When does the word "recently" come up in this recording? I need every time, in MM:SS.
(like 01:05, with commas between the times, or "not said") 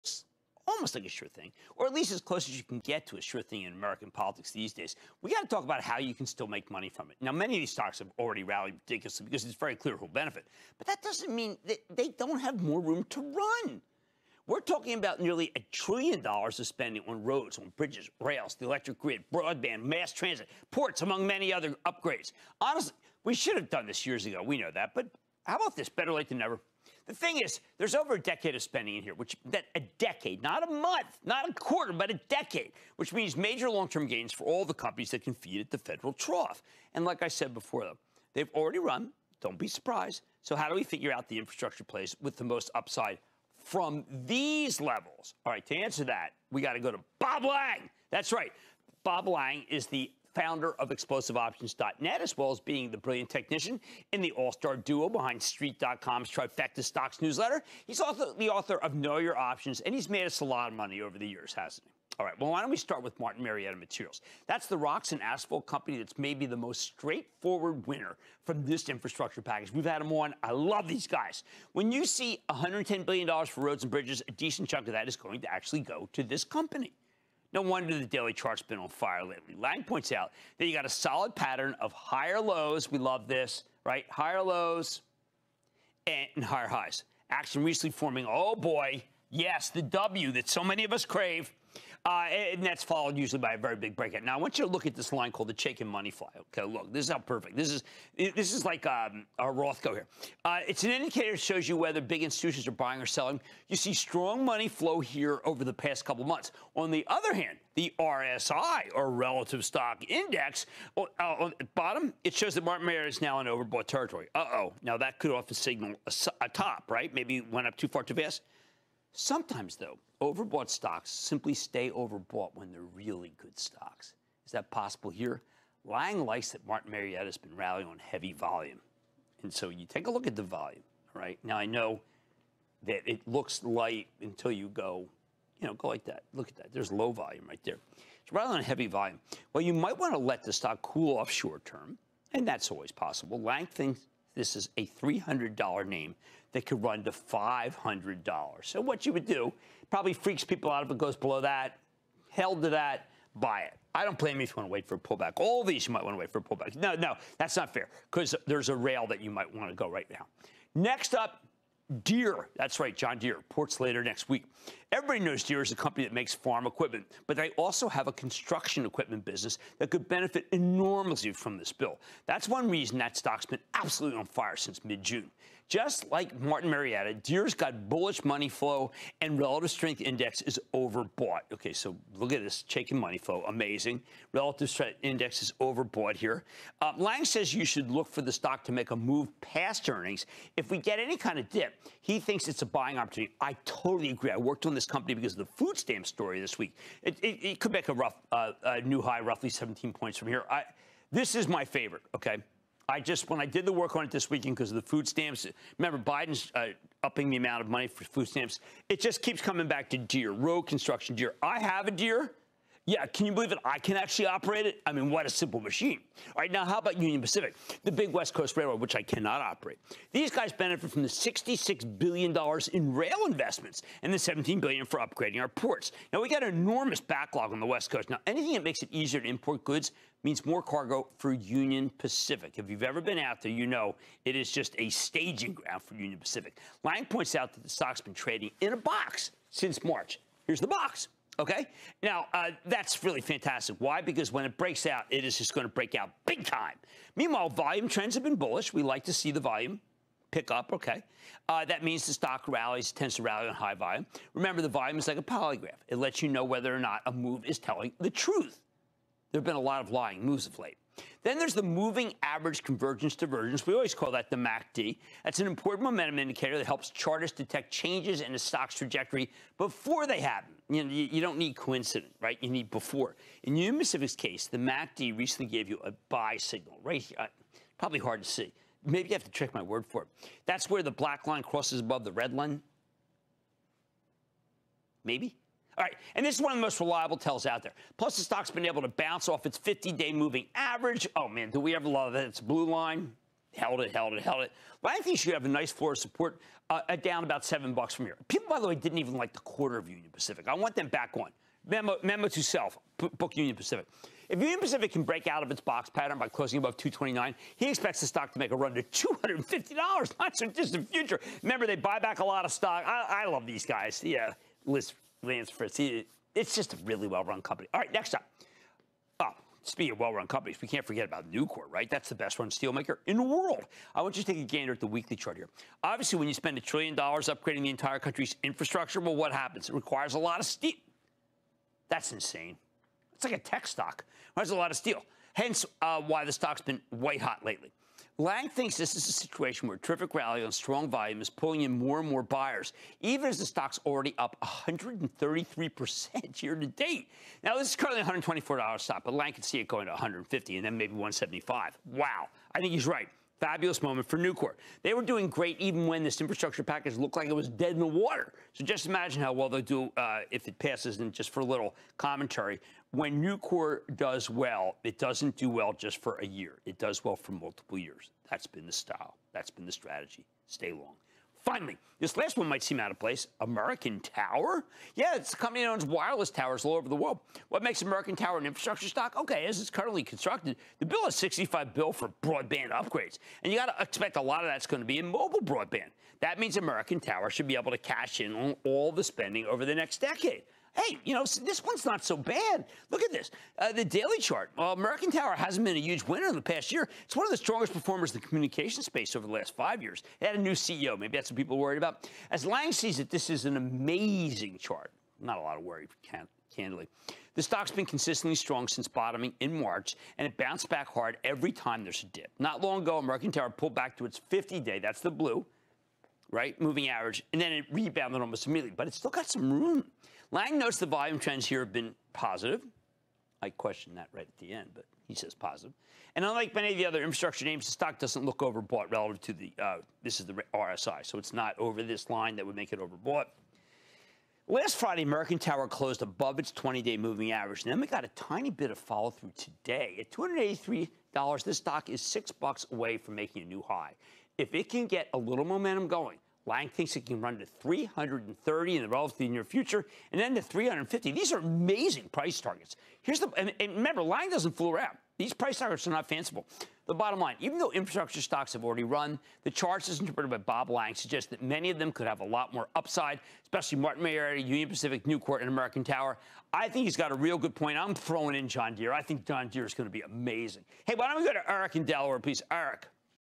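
01:27, 04:35.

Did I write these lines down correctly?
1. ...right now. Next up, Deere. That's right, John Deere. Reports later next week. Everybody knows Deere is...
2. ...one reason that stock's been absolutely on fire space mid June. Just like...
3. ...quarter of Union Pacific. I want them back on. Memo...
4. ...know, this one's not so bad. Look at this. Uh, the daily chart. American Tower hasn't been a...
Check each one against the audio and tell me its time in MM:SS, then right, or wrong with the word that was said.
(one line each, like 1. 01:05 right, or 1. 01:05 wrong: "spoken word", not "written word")
1. 02:39 right
2. 02:52 wrong: "since", not "space"
3. 04:59 right
4. 06:31 right.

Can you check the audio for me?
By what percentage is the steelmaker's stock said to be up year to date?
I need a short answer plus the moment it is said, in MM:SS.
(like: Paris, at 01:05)
133%, at 05:44.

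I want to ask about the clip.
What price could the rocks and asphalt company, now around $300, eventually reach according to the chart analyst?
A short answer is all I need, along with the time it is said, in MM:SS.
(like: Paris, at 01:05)
$500, at 02:27.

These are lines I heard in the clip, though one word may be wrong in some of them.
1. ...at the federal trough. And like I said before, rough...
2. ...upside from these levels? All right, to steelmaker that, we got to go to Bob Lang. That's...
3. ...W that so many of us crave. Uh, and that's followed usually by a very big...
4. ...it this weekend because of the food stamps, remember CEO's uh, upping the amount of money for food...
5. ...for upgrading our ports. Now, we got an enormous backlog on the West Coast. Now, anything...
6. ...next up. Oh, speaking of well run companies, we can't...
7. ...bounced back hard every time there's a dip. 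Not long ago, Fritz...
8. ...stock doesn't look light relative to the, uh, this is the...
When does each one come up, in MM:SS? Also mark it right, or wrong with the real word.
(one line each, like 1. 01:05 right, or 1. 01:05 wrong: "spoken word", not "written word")
1. 00:35 wrong: "though", not "rough"
2. 00:42 wrong: "answer", not "steelmaker"
3. 01:29 right
4. 03:24 wrong: "Biden", not "CEO"
5. 03:44 right
6. 05:17 right
7. 06:50 wrong: "American", not "Fritz"
8. 07:07 wrong: "overbought", not "light".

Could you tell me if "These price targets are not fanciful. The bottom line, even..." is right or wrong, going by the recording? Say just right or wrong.
right.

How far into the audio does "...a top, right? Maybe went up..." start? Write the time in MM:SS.
01:56.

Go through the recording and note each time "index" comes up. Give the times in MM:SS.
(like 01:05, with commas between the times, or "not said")
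01:50, 03:00, 03:05.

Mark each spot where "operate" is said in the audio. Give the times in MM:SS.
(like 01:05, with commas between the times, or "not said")
03:34, 03:39.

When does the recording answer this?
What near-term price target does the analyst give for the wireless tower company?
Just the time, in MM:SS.
07:27.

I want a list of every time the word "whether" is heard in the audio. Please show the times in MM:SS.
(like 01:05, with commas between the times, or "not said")
01:41, 04:16.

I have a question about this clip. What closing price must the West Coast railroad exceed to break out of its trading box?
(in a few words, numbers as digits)
229.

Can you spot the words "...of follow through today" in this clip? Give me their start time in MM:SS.
07:18.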